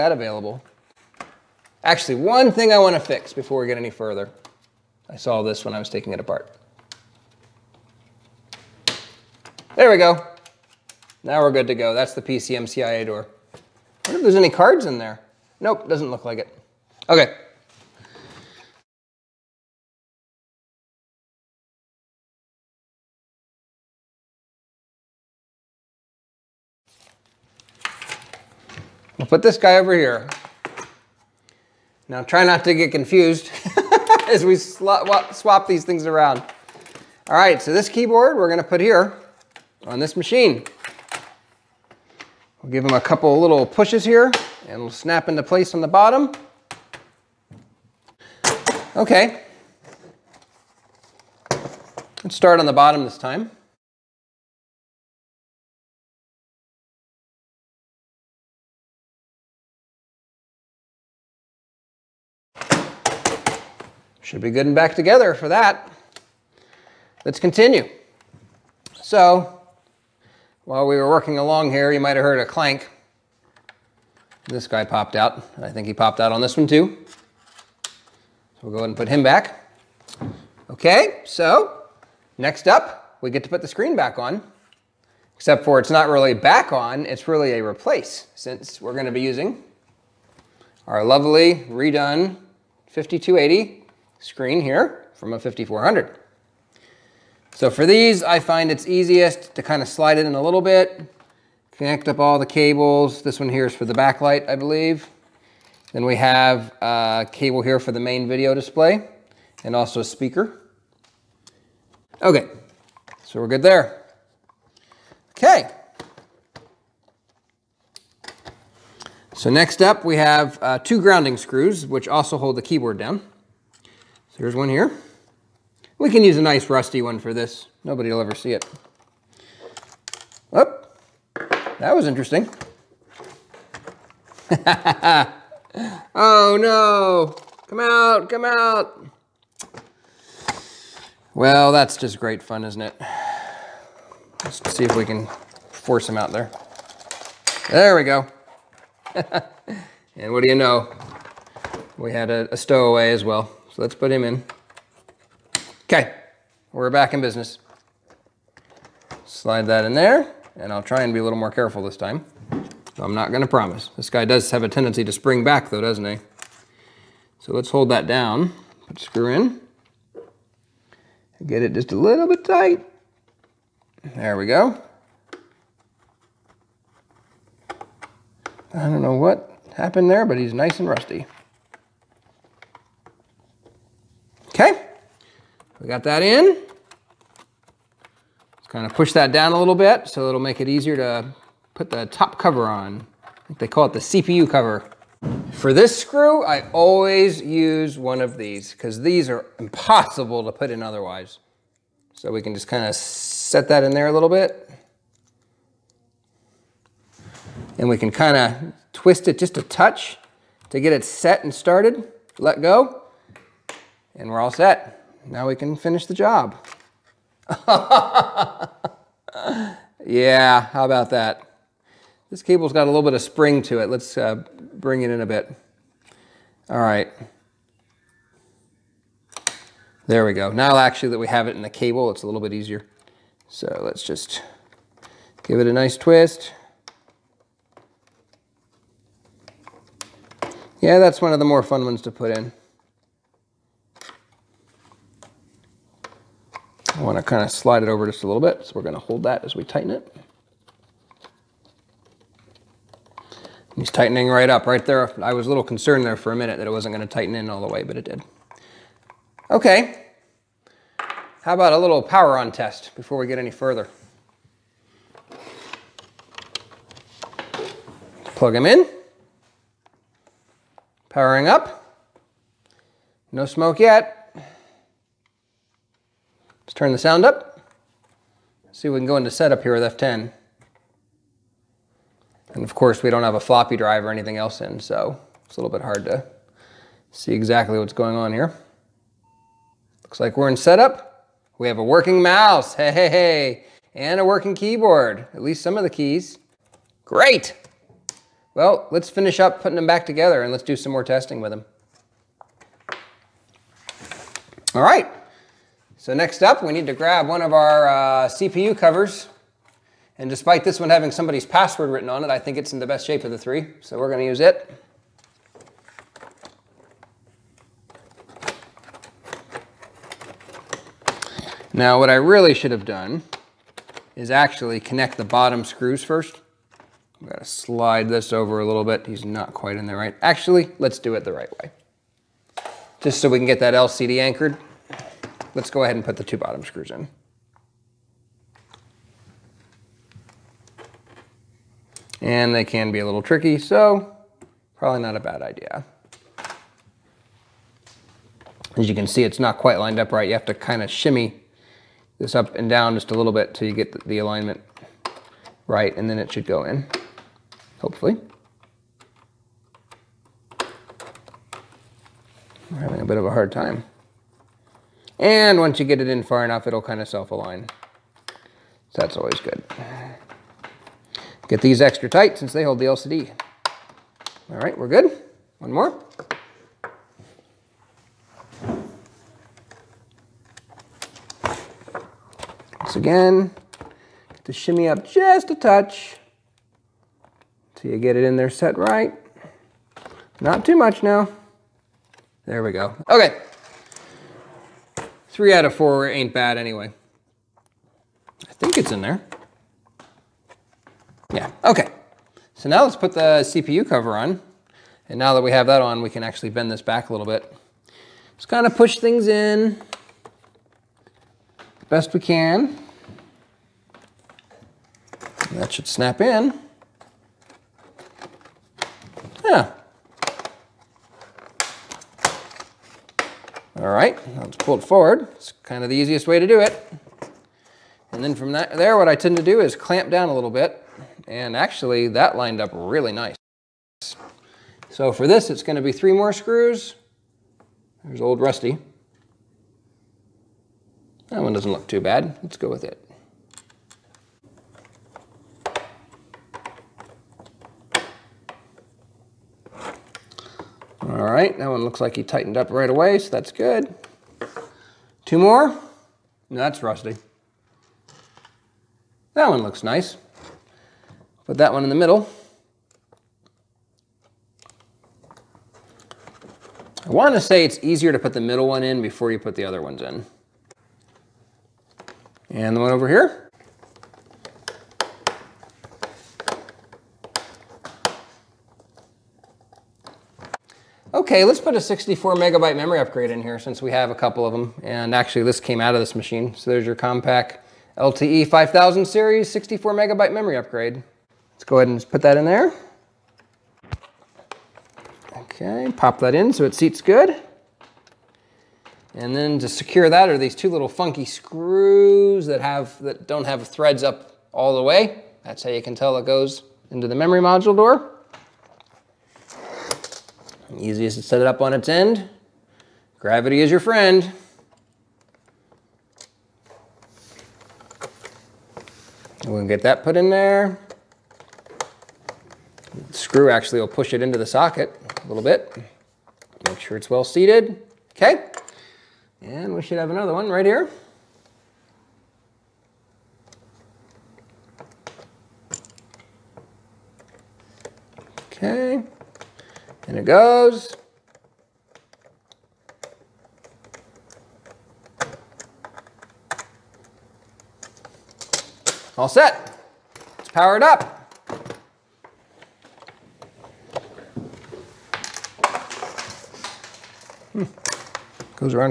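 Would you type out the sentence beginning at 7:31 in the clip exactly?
All right, that one looks like he tightened up right away, so that's good.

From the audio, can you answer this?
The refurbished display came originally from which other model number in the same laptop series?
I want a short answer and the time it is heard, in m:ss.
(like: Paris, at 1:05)
5400, at 1:35.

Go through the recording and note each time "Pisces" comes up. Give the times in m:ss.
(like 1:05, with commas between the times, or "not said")
not said.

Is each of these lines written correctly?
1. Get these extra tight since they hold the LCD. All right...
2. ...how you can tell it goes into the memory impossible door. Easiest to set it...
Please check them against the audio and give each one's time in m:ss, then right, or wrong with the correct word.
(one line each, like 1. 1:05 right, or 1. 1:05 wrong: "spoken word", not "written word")
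1. 6:11 right
2. 8:25 wrong: "module", not "impossible".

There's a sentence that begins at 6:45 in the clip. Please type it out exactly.
And now that we have that on, we can actually bend this back a little bit.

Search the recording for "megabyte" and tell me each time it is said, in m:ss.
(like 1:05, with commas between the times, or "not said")
8:02, 8:09.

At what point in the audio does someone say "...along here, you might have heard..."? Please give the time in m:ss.
1:11.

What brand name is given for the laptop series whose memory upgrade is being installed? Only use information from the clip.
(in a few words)
Compaq.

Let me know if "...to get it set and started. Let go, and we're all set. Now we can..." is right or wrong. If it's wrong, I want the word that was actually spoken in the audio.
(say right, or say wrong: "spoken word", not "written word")
right.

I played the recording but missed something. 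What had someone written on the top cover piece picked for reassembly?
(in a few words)
password.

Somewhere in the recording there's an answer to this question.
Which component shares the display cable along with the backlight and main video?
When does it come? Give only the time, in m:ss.
1:50.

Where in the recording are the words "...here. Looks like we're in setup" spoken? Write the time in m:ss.
4:48.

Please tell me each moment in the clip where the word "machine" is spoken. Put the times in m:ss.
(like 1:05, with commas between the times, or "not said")
0:40, 8:06.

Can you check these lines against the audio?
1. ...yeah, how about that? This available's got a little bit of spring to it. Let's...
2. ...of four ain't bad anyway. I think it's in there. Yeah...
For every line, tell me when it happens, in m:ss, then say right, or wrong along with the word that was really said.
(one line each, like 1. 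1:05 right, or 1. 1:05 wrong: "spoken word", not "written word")
1. 3:40 wrong: "cable", not "available"
2. 6:35 right.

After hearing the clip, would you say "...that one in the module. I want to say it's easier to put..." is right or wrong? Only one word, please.
wrong.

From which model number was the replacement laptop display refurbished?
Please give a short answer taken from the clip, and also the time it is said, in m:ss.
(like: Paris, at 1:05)
5280, at 1:32.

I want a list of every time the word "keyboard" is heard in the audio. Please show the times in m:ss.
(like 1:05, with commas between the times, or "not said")
0:37, 2:02, 4:54.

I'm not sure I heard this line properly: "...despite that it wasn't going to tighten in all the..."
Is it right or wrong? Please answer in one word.
wrong.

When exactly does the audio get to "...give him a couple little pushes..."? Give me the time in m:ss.
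0:42.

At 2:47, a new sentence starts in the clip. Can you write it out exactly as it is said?
So let's hold that down, put screw in, get it just a little bit tight.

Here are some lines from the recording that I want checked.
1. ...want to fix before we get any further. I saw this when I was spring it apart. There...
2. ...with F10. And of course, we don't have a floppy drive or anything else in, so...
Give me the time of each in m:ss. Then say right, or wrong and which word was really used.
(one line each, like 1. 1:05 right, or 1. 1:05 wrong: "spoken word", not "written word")
1. 0:02 wrong: "taking", not "spring"
2. 4:39 right.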